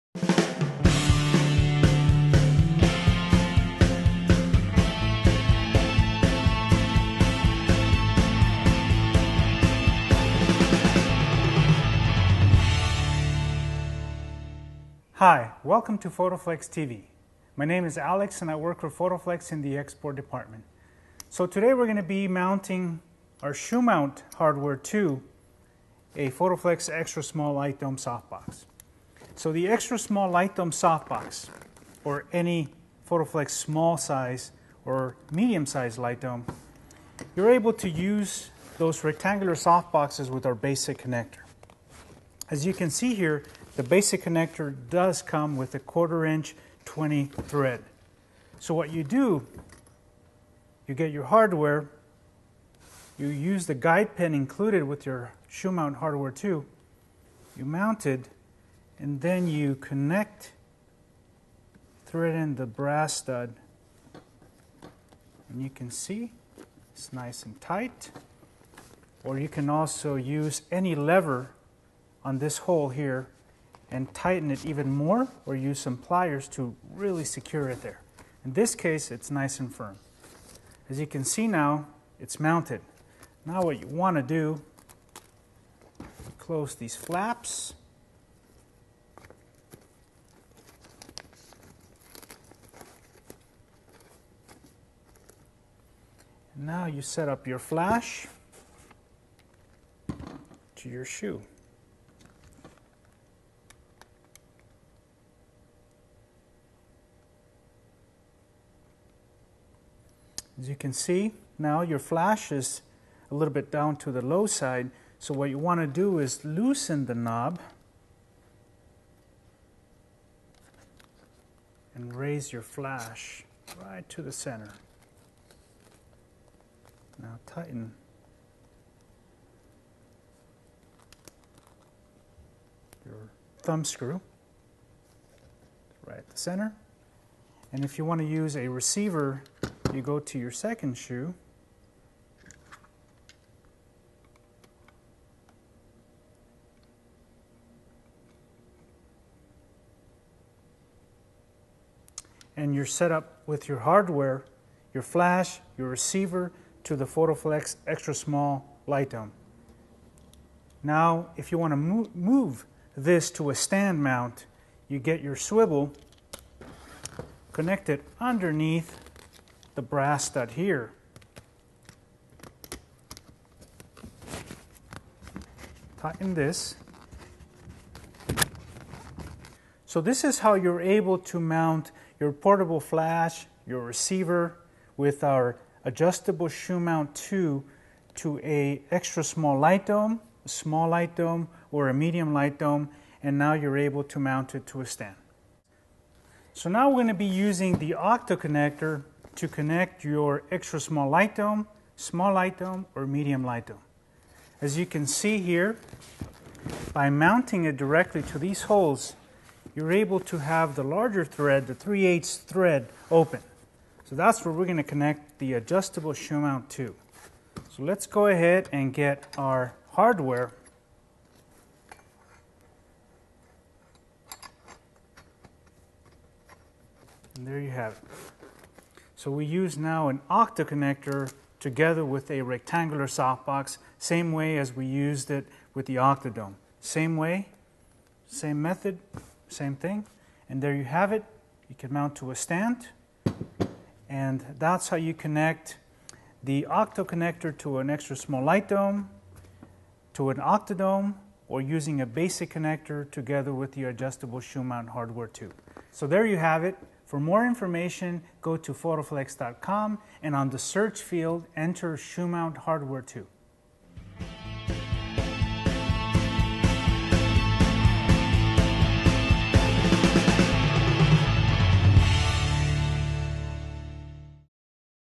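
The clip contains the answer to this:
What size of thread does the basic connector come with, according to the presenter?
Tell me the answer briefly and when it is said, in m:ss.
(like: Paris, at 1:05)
1/4-20, at 0:45.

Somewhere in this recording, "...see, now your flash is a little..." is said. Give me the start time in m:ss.
1:50.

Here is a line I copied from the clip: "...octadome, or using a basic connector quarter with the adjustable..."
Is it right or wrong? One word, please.
wrong.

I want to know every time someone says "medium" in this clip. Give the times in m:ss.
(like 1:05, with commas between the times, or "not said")
0:35, 3:11, 3:23.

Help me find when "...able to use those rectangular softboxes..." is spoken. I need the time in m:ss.
0:37.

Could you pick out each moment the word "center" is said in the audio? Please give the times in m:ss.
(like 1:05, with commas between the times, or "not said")
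2:04, 2:16.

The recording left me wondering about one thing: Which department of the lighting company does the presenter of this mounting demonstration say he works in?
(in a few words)
Export department.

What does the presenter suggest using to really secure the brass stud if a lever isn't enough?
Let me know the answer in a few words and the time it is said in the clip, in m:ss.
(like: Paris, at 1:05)
Pliers, at 1:15.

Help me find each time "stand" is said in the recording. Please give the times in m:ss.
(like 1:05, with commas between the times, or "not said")
2:43, 3:14, 4:02.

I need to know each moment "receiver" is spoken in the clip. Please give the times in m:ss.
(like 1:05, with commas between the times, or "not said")
2:18, 2:35, 3:03.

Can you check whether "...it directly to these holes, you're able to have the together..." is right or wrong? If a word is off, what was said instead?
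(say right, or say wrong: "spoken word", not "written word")
wrong: "larger", not "together".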